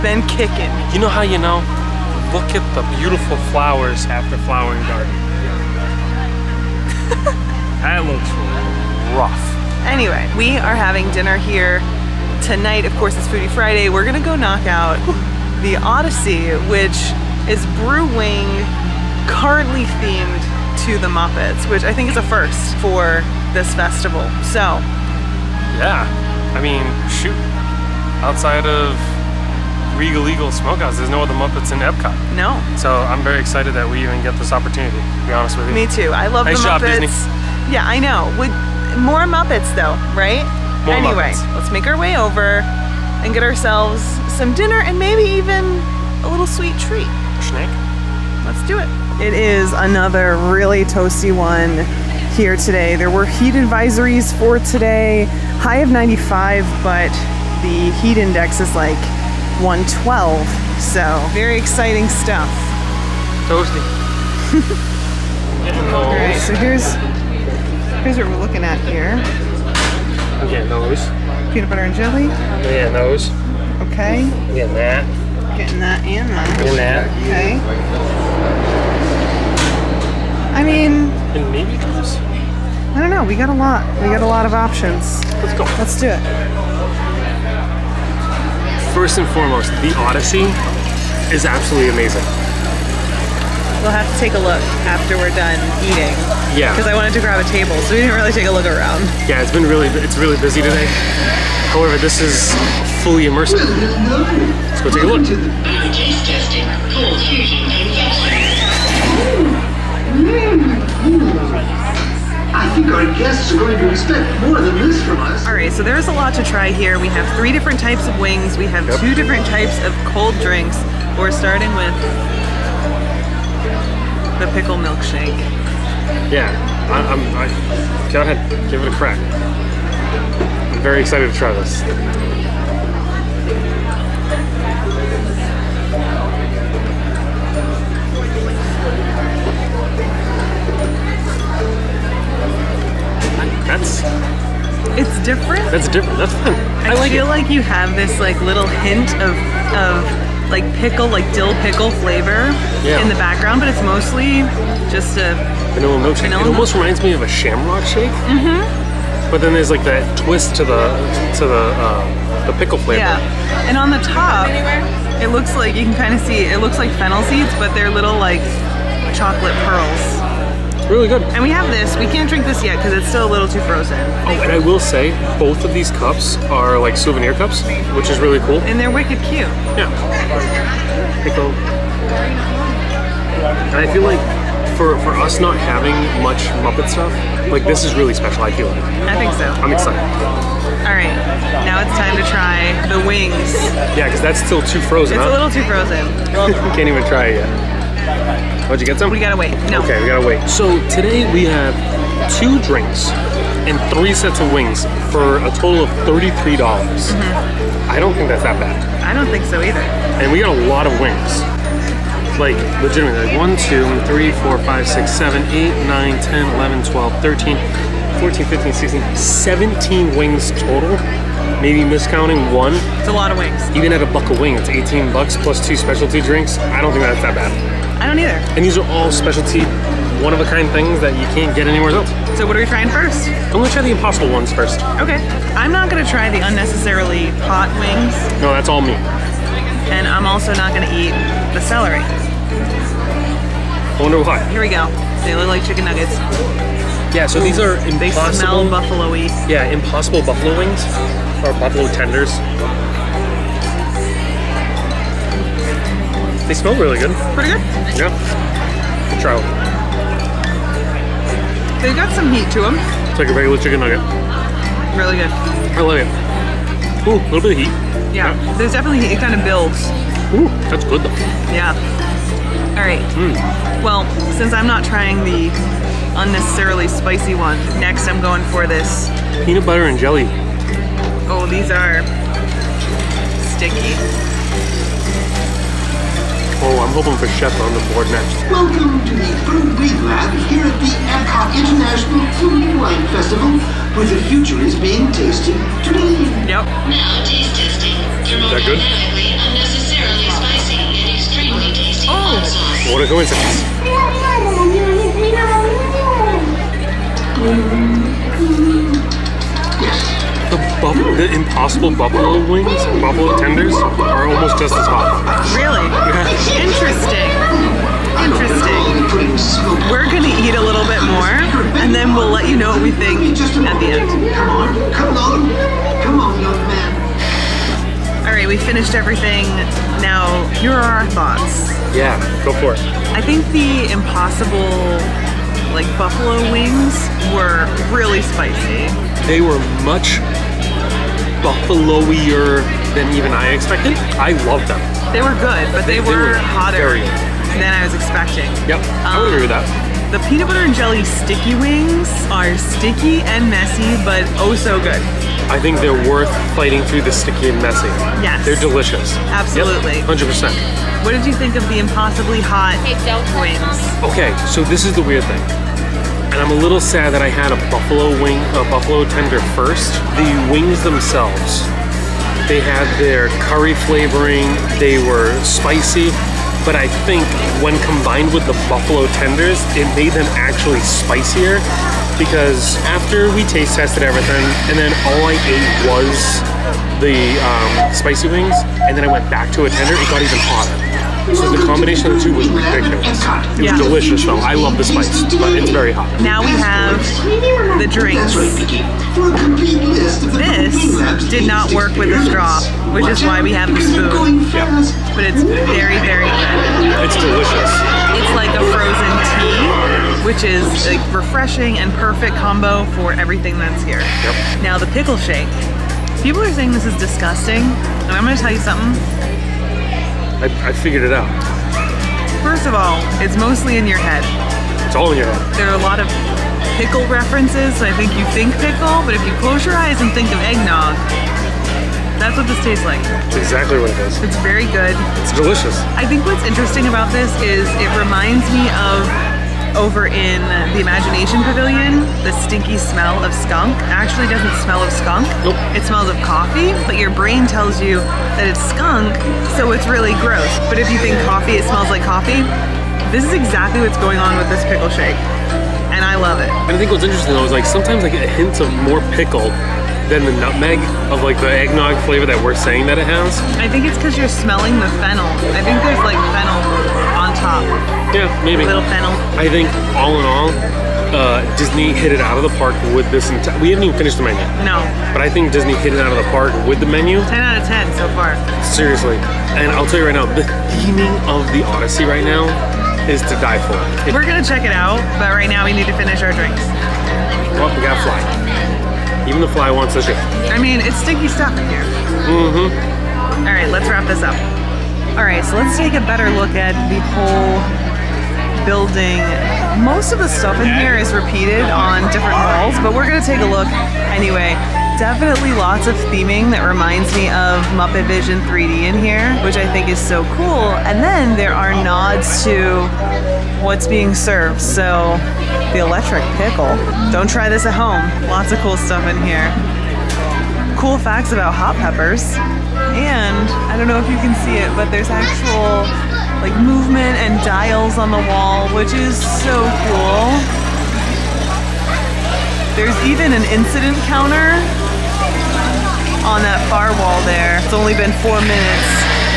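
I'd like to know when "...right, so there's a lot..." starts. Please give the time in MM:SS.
01:55.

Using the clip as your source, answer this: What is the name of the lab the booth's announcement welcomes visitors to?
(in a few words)
Brew-Wing Lab.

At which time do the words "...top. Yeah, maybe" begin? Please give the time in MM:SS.
07:47.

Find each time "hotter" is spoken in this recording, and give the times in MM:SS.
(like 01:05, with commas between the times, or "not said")
05:46, 06:30.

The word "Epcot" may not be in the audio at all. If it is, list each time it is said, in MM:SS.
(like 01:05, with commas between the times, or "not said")
00:31, 04:51.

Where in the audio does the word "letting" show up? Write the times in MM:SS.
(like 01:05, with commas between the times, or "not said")
not said.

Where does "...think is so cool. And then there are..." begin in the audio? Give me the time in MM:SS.
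08:29.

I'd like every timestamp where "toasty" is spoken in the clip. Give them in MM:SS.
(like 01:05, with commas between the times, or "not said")
00:50, 01:03.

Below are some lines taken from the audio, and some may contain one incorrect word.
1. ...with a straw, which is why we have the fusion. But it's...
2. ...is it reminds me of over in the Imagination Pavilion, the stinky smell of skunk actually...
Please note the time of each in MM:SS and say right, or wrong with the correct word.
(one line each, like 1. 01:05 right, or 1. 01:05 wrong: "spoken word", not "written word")
1. 06:41 wrong: "spoon", not "fusion"
2. 07:17 right.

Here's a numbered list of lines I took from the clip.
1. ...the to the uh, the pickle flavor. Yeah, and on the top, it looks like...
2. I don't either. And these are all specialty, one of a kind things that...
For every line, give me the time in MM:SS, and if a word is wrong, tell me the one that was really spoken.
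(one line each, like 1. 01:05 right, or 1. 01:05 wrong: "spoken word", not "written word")
1. 02:40 right
2. 03:47 right.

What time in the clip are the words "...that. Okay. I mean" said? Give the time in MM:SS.
01:16.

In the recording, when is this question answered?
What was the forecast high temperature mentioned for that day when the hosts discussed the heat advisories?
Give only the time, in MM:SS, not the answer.
00:55.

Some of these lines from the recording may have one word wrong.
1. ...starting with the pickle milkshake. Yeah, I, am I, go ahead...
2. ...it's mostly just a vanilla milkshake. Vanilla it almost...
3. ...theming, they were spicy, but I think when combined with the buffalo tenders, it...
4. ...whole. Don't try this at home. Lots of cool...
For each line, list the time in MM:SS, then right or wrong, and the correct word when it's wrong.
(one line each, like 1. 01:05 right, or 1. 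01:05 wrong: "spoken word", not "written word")
1. 02:01 right
2. 02:33 right
3. 06:13 wrong: "flavoring", not "theming"
4. 08:36 wrong: "pickle", not "whole".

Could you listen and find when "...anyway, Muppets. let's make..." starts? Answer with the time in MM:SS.
00:40.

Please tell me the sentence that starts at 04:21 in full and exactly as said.
They've got some heat to them.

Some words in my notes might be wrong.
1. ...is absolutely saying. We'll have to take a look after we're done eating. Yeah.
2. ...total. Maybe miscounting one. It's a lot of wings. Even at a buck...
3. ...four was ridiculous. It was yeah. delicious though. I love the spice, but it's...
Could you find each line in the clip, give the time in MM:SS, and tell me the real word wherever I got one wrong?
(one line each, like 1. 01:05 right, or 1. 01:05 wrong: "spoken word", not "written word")
1. 01:31 wrong: "amazing", not "saying"
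2. 03:40 right
3. 06:32 wrong: "two", not "four".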